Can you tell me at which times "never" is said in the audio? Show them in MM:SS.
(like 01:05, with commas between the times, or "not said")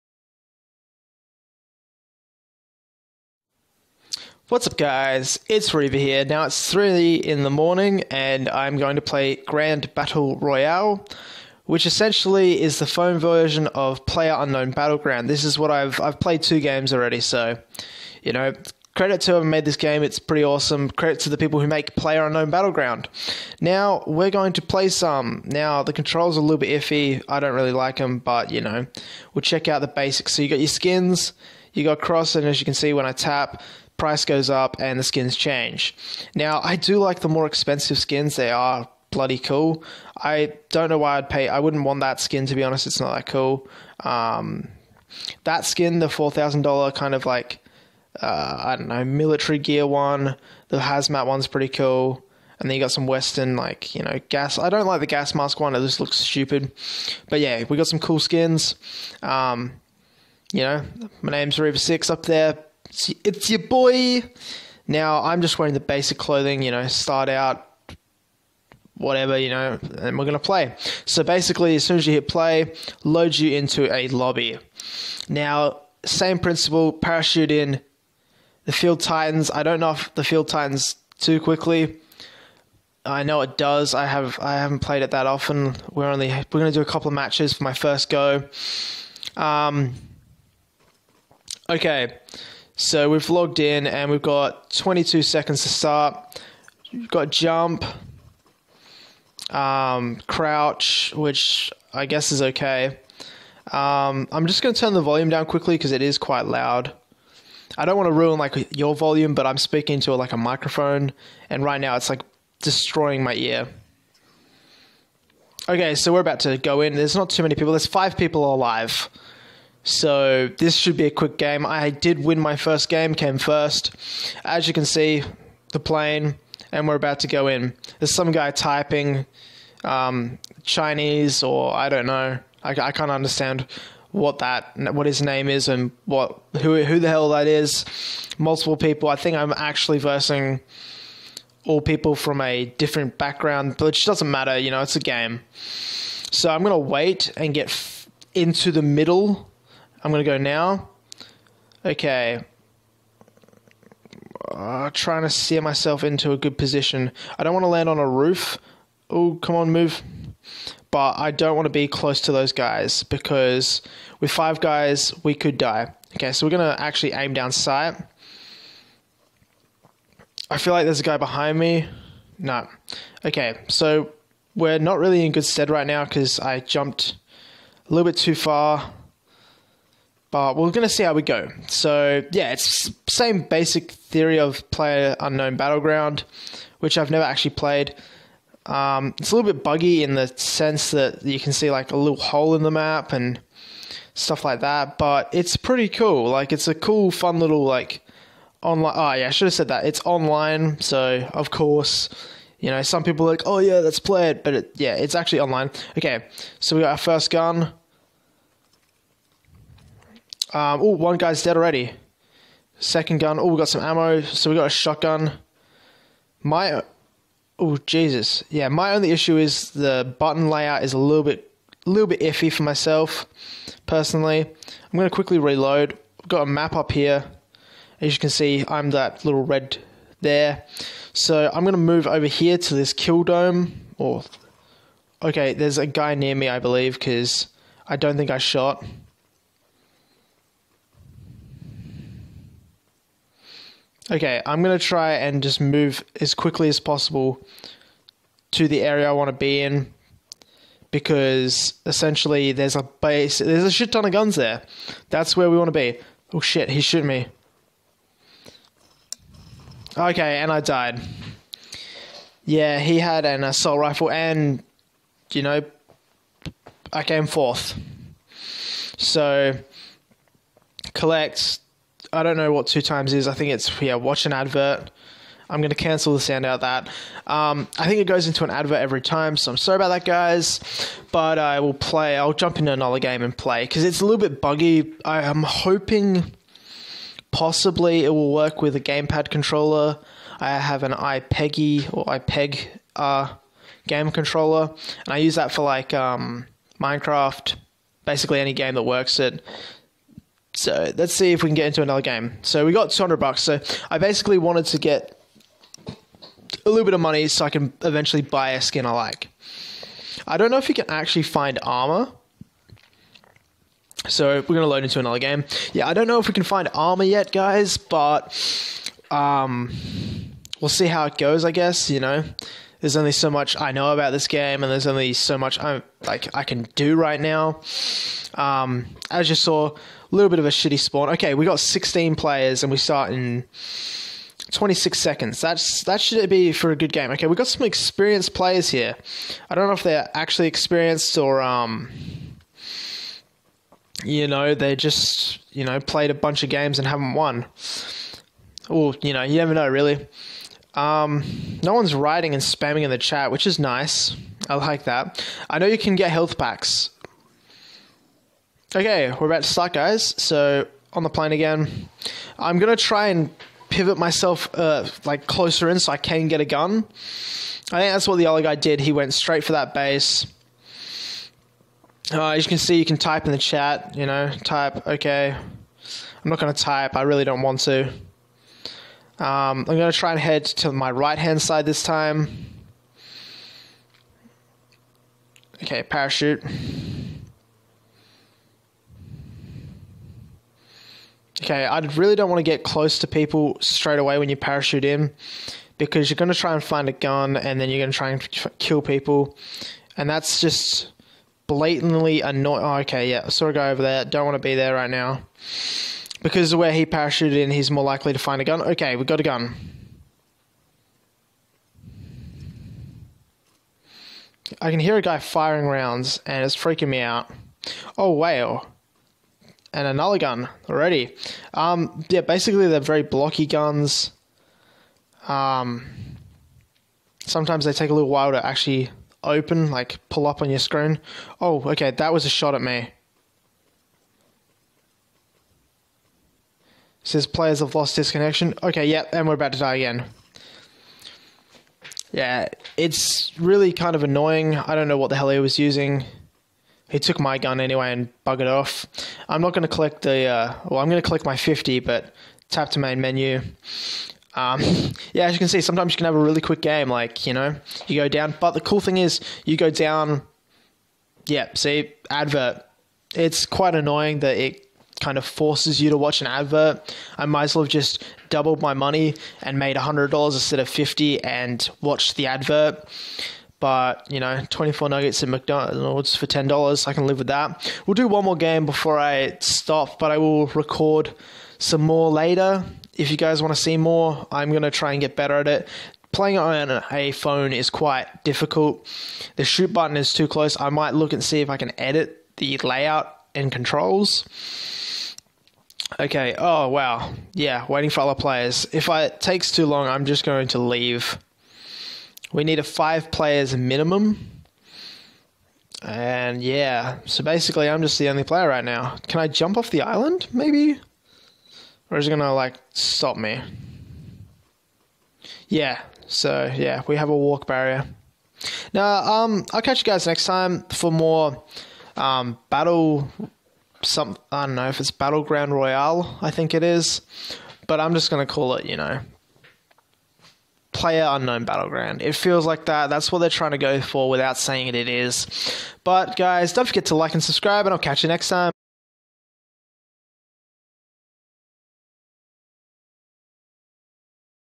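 03:07, 05:49.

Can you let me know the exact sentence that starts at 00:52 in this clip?
And then you got some Western, like, you know, gas.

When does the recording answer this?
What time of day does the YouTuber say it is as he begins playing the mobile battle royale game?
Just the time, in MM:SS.
00:06.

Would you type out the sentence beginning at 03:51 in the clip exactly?
So I'm going to move over here to this kill dome.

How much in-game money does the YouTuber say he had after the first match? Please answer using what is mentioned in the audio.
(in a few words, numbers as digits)
200 bucks.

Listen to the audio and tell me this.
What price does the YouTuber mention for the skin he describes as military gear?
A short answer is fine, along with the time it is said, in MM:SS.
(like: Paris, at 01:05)
$4,000, at 00:46.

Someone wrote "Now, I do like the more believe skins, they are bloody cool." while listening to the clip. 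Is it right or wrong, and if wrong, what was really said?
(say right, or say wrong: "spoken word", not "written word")
wrong: "expensive", not "believe".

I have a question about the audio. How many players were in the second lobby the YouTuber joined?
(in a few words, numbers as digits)
16.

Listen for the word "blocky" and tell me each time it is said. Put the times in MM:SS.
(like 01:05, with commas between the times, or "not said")
07:03.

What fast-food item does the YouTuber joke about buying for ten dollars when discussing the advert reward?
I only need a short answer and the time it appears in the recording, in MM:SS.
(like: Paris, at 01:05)
24 nuggets, at 07:54.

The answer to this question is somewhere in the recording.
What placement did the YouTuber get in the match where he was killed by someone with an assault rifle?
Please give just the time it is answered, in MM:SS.
04:27.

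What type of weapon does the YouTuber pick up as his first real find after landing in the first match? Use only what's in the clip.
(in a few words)
shotgun.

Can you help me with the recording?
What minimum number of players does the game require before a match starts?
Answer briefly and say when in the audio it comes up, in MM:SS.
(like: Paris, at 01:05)
5, at 08:22.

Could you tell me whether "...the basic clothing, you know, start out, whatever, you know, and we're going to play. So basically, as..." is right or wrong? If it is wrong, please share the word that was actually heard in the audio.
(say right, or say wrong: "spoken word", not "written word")
right.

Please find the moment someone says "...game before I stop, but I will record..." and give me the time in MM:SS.
07:58.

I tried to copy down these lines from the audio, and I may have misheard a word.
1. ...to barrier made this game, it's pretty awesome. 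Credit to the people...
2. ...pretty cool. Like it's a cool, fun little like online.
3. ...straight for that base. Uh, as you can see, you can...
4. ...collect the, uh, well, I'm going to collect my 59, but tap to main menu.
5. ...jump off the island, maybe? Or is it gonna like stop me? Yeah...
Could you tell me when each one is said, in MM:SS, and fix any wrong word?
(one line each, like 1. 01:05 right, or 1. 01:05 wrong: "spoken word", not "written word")
1. 00:19 wrong: "whoever", not "barrier"
2. 03:15 right
3. 06:09 right
4. 07:29 wrong: "50", not "59"
5. 08:29 right.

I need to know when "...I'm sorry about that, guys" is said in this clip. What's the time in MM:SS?
04:39.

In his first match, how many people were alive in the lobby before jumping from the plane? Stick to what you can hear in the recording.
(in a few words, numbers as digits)
5.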